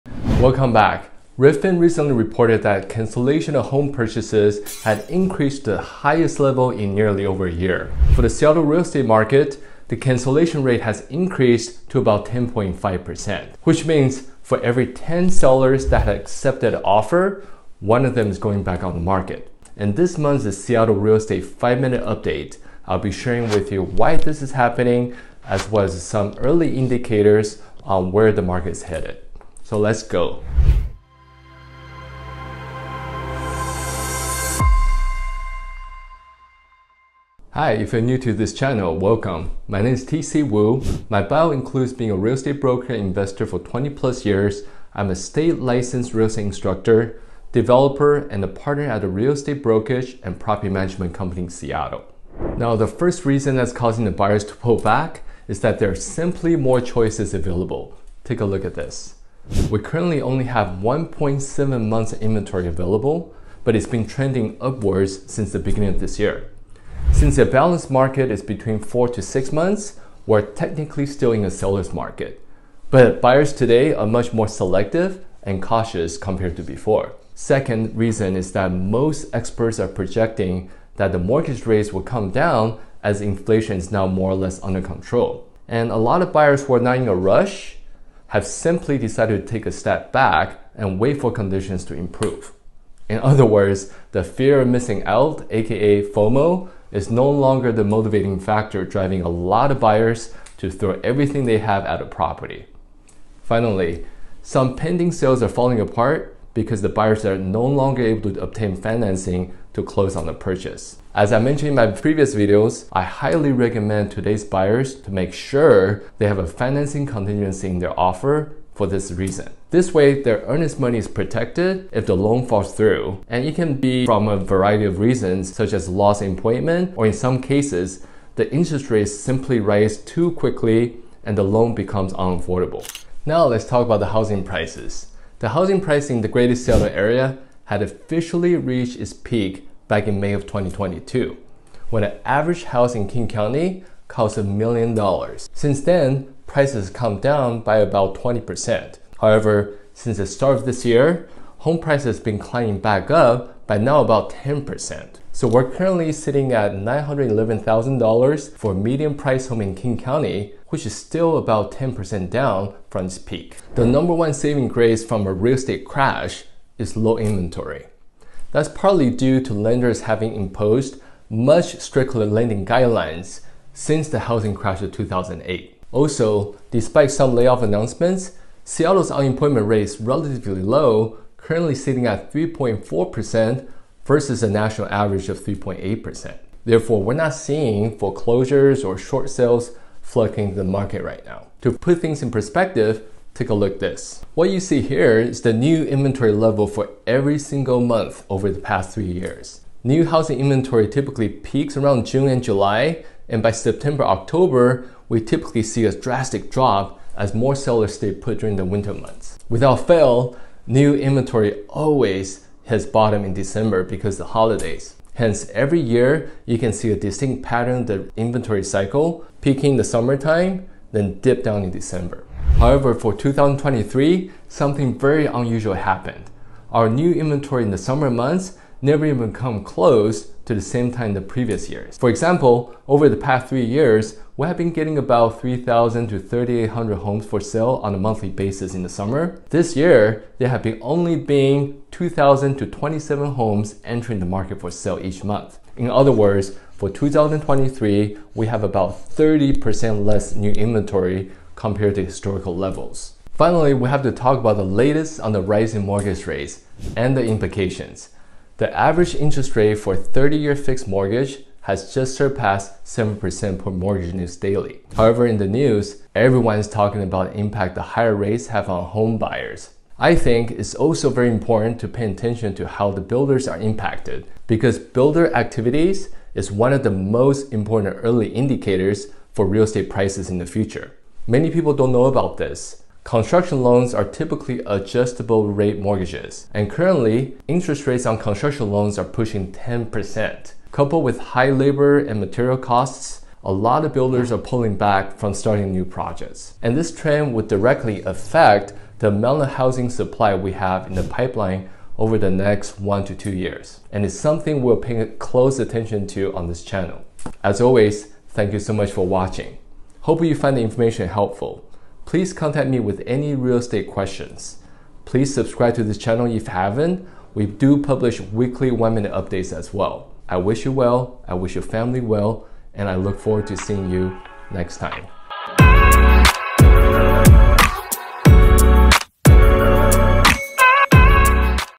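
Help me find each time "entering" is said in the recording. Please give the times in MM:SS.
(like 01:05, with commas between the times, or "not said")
04:03.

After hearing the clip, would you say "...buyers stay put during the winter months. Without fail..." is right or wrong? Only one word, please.
wrong.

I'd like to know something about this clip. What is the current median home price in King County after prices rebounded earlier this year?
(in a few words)
$911,000.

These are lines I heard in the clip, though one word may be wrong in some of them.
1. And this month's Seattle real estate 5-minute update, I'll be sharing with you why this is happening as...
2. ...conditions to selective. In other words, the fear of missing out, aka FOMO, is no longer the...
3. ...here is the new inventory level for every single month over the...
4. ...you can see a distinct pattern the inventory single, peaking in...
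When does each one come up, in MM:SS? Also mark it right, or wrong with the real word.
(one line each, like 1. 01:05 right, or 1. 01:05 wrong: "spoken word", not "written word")
1. 00:19 right
2. 01:31 wrong: "improve", not "selective"
3. 03:14 right
4. 03:36 wrong: "cycle", not "single".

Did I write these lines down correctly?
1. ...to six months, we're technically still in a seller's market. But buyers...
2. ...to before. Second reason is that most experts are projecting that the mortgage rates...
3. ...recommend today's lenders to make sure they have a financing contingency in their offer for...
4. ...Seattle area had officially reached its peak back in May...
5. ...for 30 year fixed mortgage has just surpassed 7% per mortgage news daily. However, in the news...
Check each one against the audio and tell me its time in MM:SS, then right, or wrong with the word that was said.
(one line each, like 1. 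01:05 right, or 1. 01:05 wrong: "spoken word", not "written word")
1. 01:09 right
2. 01:16 right
3. 01:53 wrong: "buyers", not "lenders"
4. 02:16 right
5. 04:19 right.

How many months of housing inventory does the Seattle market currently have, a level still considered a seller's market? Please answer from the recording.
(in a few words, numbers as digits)
1.7 months.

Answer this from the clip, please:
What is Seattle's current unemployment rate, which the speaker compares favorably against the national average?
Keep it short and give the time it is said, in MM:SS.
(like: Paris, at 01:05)
3.4%, at 03:02.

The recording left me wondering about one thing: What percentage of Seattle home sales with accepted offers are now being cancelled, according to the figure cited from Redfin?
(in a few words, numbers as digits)
10.5%.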